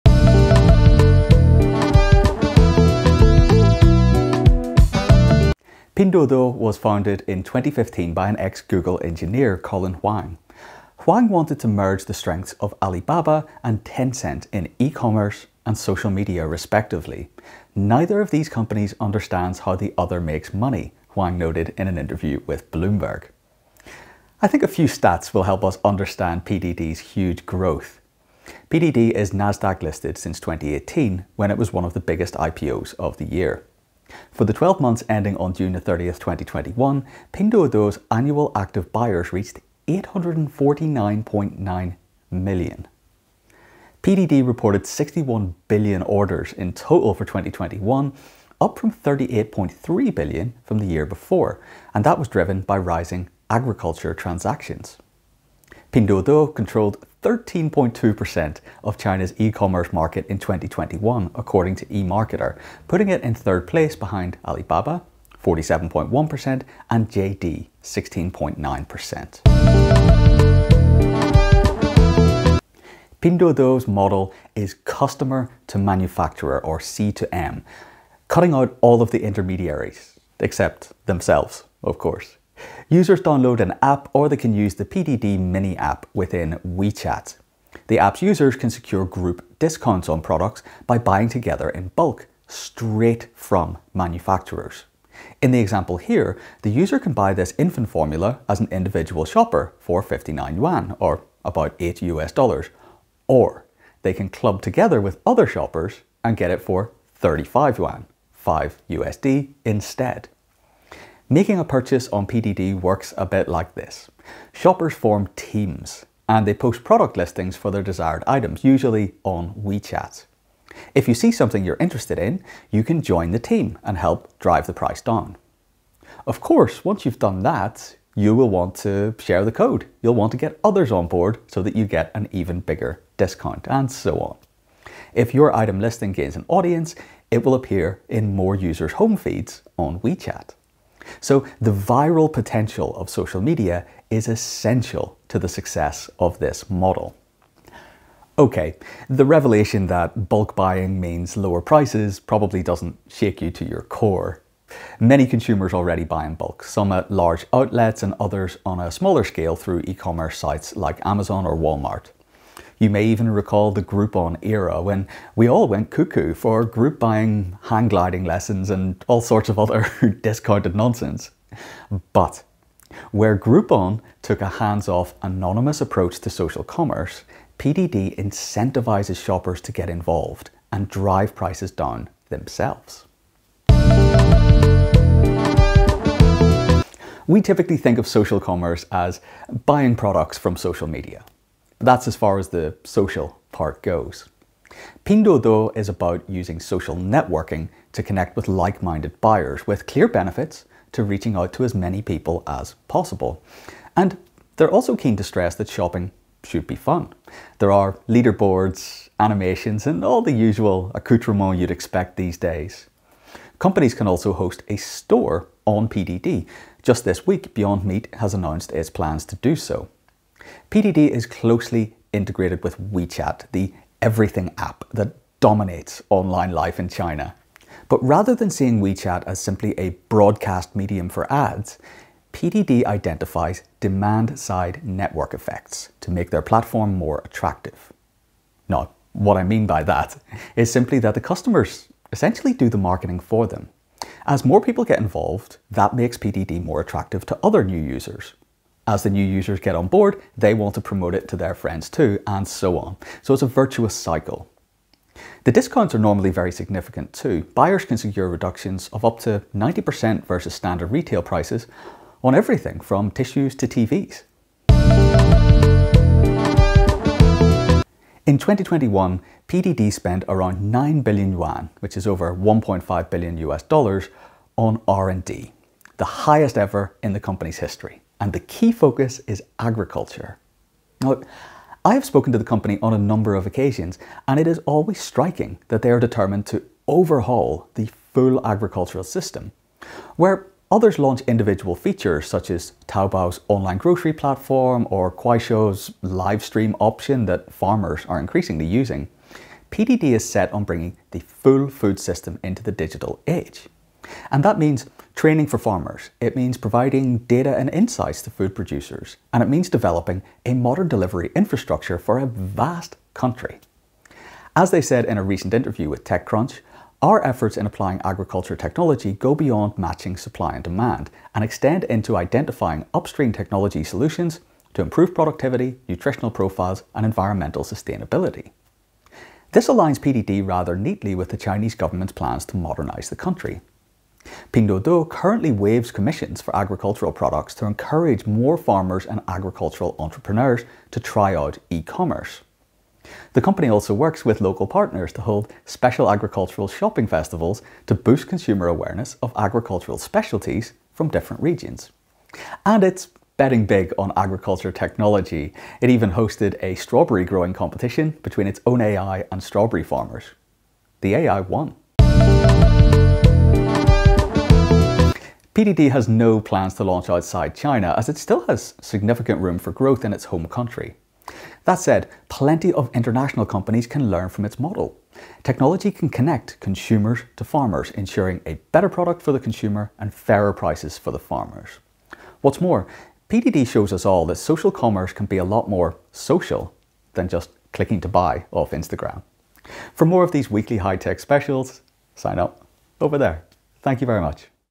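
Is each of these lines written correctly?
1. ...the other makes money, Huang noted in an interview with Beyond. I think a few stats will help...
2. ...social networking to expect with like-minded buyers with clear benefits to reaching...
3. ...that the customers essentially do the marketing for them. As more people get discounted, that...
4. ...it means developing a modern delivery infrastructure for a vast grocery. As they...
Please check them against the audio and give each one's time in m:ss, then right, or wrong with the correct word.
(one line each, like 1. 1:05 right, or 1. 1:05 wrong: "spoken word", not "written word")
1. 0:19 wrong: "Bloomberg", not "Beyond"
2. 3:16 wrong: "connect", not "expect"
3. 4:00 wrong: "involved", not "discounted"
4. 5:09 wrong: "country", not "grocery".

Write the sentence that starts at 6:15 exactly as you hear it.
Technology can connect consumers to farmers, ensuring a better product for the consumer and fairer prices for the farmers.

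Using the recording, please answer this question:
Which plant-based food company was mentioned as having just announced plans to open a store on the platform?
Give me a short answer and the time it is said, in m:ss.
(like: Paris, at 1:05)
Beyond Meat, at 3:37.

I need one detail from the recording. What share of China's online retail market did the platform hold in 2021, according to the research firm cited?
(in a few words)
13.2%.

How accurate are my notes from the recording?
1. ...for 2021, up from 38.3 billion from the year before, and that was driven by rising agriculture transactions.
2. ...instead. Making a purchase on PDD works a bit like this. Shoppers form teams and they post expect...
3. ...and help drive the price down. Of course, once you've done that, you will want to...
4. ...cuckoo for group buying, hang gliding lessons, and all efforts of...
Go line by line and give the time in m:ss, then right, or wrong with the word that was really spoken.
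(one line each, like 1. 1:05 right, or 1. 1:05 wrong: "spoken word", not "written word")
1. 0:47 right
2. 1:49 wrong: "product", not "expect"
3. 2:03 right
4. 2:45 wrong: "sorts", not "efforts".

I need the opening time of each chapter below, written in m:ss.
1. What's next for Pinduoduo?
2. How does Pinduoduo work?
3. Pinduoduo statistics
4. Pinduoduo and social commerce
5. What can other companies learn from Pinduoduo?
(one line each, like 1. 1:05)
1. 4:25
2. 1:11
3. 0:30
4. 3:06
5. 6:03.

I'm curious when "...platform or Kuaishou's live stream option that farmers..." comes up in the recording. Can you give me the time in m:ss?
4:54.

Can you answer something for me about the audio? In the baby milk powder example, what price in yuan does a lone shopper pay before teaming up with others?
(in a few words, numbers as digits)
59 yuan.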